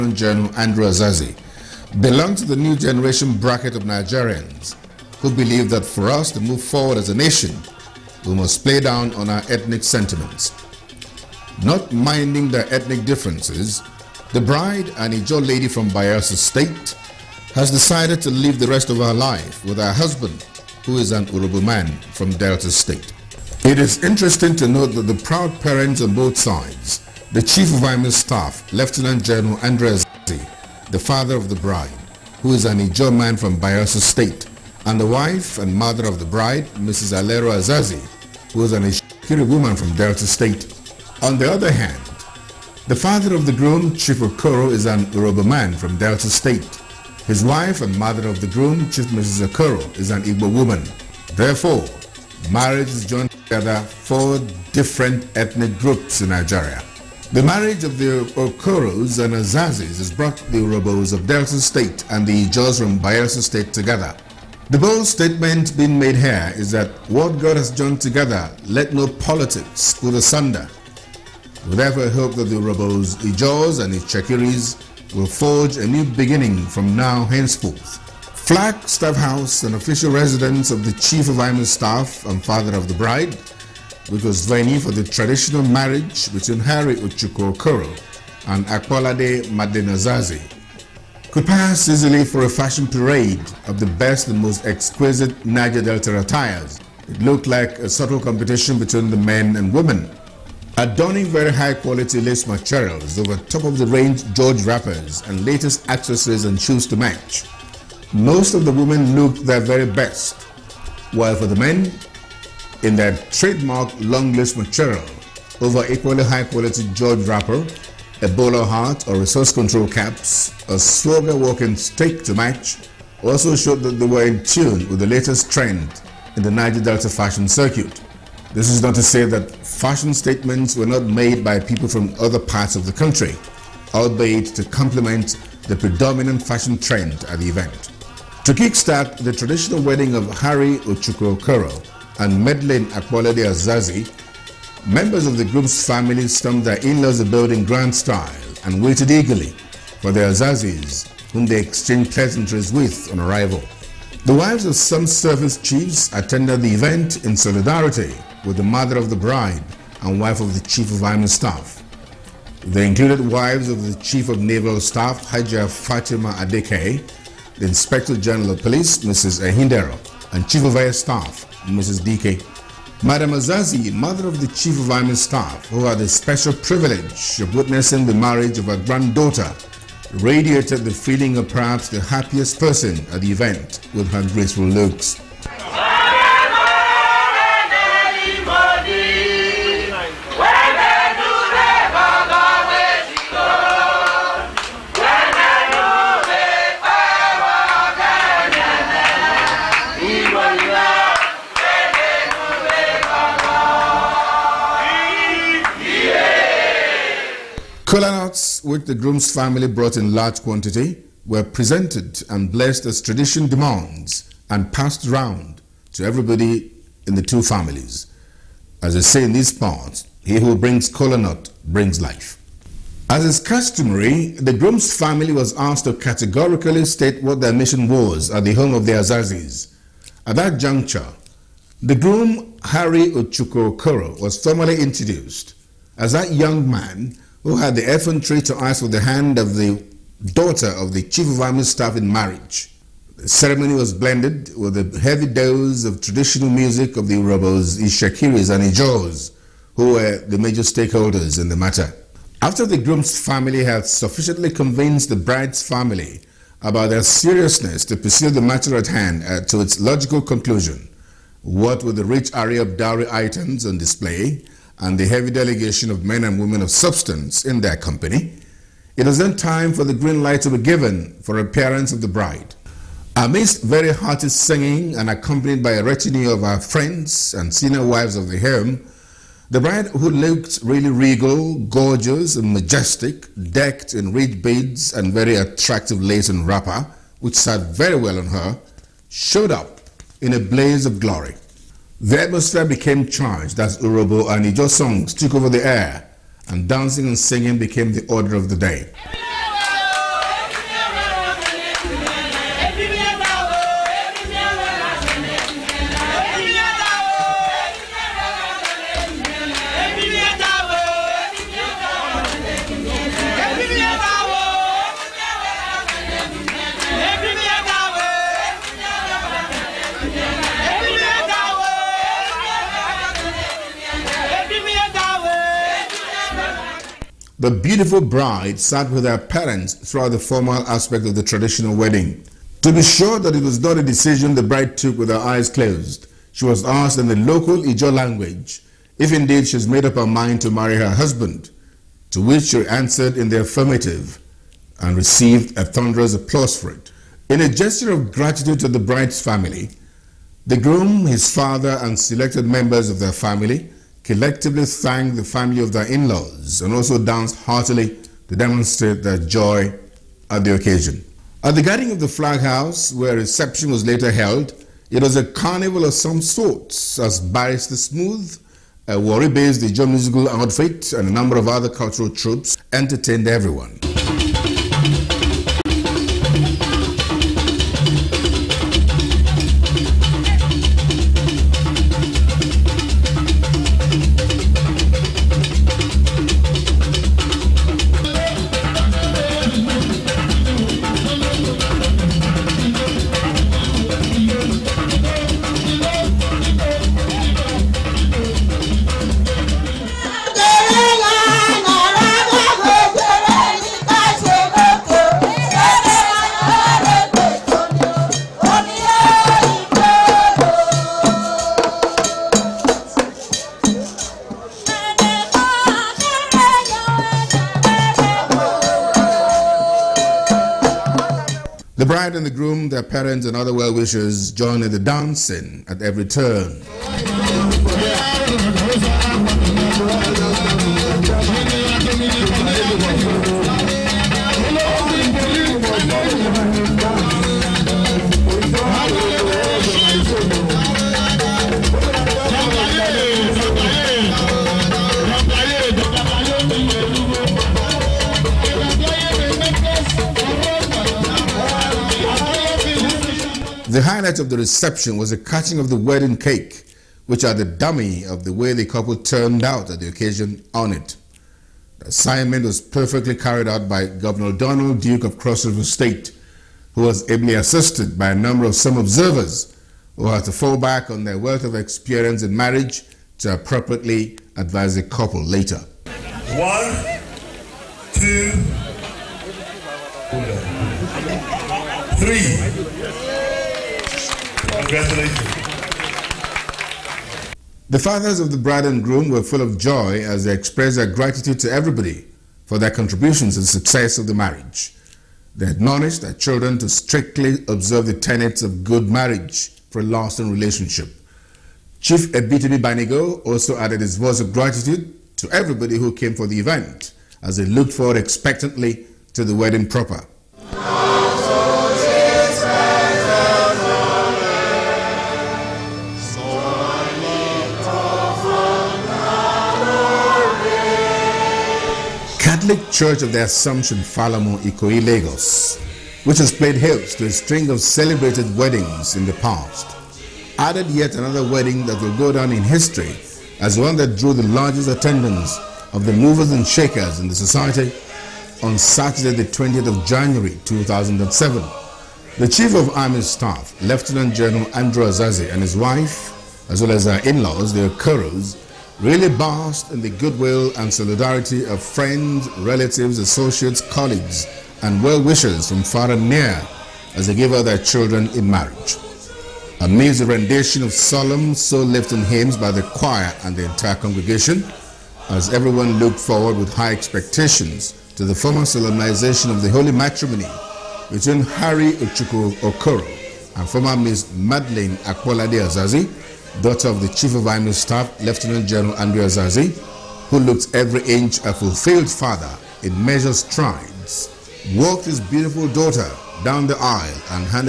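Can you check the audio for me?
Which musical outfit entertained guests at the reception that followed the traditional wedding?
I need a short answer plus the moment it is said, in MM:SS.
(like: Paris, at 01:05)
Barrister Smooth, at 06:07.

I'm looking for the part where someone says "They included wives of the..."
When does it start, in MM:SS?
02:42.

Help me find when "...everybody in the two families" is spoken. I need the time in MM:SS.
03:36.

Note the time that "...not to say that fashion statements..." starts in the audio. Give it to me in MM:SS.
02:08.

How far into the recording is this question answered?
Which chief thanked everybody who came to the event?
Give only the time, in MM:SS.
08:22.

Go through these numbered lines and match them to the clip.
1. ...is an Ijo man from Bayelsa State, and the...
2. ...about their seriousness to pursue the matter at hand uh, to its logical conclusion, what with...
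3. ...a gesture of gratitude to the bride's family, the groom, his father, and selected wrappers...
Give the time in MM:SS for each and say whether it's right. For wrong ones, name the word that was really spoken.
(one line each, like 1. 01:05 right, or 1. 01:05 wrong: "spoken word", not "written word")
1. 00:32 right
2. 04:16 right
3. 05:47 wrong: "members", not "wrappers".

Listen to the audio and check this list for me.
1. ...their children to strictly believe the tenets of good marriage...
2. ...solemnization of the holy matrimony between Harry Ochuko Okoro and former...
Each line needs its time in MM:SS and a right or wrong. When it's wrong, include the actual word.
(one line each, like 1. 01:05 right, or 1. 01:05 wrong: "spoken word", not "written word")
1. 08:16 wrong: "observe", not "believe"
2. 09:28 right.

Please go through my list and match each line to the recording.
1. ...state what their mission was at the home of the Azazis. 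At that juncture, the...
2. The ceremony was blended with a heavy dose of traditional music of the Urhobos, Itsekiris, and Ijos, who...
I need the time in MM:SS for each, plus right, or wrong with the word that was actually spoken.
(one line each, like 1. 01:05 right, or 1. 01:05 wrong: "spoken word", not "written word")
1. 03:46 right
2. 04:03 right.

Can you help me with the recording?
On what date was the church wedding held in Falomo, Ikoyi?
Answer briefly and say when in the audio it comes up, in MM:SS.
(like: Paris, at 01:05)
20 January 2007, at 08:59.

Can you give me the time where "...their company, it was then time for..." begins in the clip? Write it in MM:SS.
04:27.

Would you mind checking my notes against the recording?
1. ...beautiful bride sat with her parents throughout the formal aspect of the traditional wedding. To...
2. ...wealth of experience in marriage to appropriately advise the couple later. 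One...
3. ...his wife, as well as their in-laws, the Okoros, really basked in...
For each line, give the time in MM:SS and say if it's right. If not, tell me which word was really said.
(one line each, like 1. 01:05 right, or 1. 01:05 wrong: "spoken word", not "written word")
1. 05:27 right
2. 07:51 right
3. 09:05 right.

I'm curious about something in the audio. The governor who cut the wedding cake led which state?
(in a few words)
Cross River State.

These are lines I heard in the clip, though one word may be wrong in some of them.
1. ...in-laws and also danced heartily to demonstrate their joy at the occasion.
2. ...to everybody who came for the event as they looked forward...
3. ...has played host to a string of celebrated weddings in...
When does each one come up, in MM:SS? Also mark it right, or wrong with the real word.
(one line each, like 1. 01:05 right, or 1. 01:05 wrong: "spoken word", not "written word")
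1. 05:55 right
2. 08:25 right
3. 08:46 right.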